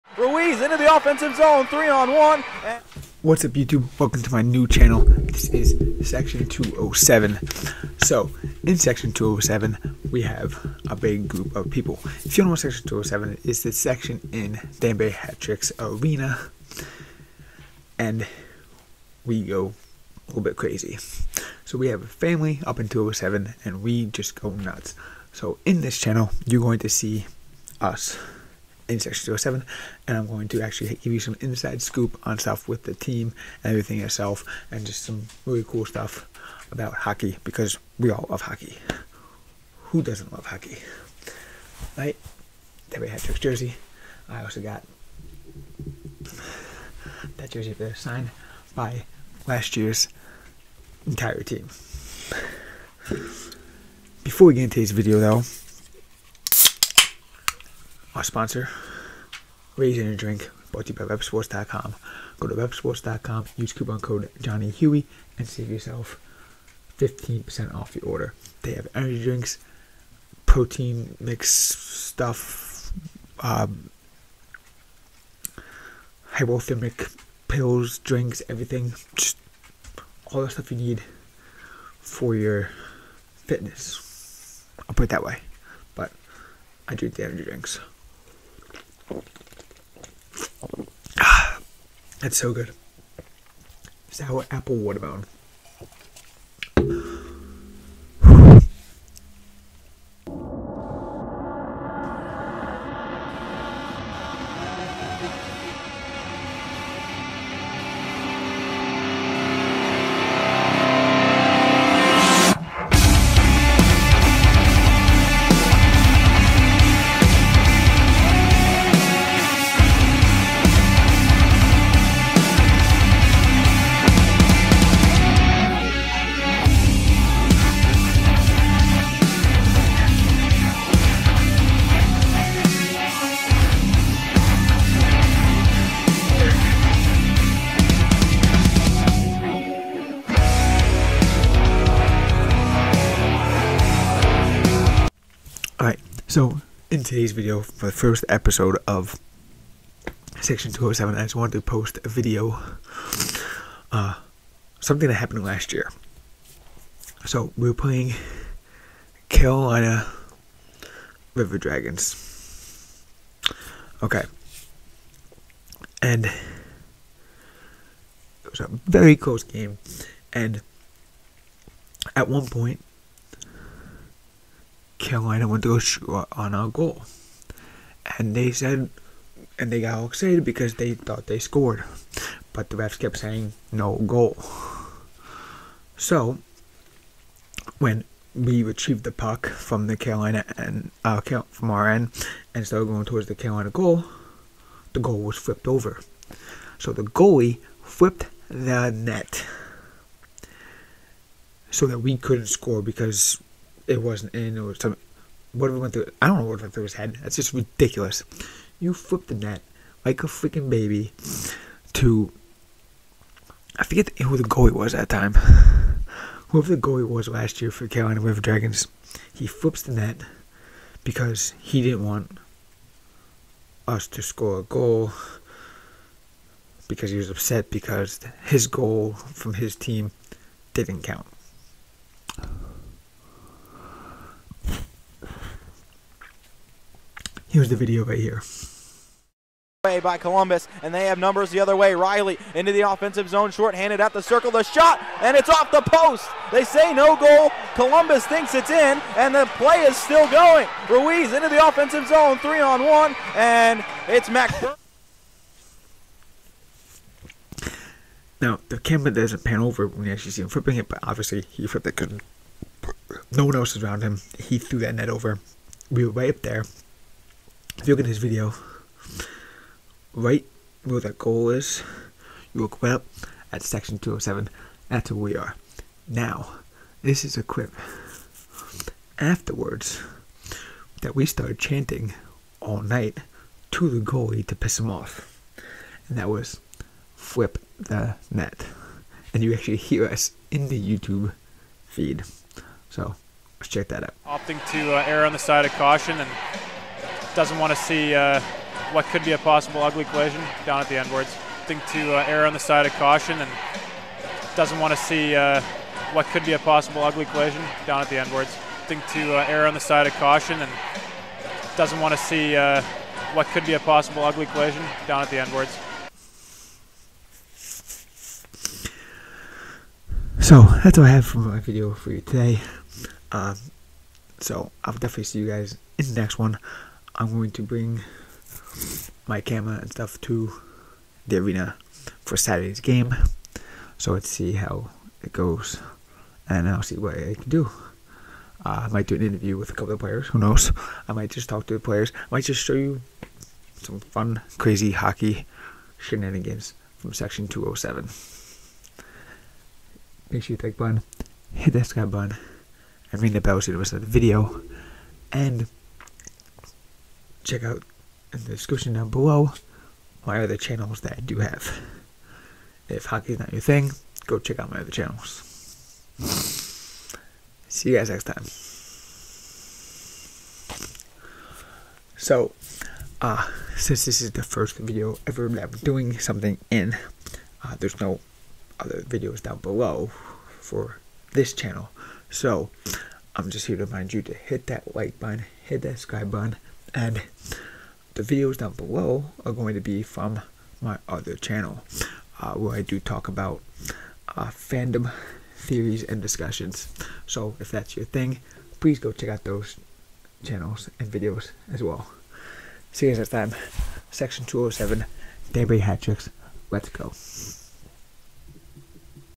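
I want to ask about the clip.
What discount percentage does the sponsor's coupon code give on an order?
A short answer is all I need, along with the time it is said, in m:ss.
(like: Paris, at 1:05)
15%, at 1:06.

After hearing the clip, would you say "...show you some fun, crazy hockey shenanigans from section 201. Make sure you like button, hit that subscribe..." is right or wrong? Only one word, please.
wrong.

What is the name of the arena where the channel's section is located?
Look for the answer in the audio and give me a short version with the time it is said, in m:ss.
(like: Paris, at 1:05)
Danbury Hat Tricks Arena, at 0:14.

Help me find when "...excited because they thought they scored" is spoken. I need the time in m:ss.
3:00.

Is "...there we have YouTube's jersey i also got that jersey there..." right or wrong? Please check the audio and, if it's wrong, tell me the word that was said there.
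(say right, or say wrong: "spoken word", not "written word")
wrong: "Trick", not "YouTube".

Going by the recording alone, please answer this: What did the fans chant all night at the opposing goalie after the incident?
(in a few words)
Flip the net.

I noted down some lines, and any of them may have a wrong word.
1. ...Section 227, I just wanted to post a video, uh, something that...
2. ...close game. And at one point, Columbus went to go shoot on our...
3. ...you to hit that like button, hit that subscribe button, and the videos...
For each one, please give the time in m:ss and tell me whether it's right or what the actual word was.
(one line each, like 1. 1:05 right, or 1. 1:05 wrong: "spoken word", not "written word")
1. 2:30 wrong: "207", not "227"
2. 2:49 wrong: "Carolina", not "Columbus"
3. 6:24 right.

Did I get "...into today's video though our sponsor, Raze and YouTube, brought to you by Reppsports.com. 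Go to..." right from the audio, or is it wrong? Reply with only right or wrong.
wrong.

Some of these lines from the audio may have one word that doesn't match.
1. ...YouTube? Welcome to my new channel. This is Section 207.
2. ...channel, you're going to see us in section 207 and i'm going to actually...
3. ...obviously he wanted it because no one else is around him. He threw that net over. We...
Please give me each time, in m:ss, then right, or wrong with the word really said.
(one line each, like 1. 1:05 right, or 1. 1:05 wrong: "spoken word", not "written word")
1. 0:03 right
2. 0:25 right
3. 4:21 wrong: "flipped", not "wanted".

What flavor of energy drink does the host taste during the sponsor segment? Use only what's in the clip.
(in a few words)
Sour apple watermelon.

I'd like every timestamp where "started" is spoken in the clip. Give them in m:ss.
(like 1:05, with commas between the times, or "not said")
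3:12, 4:41.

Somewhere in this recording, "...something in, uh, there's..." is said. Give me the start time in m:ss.
6:16.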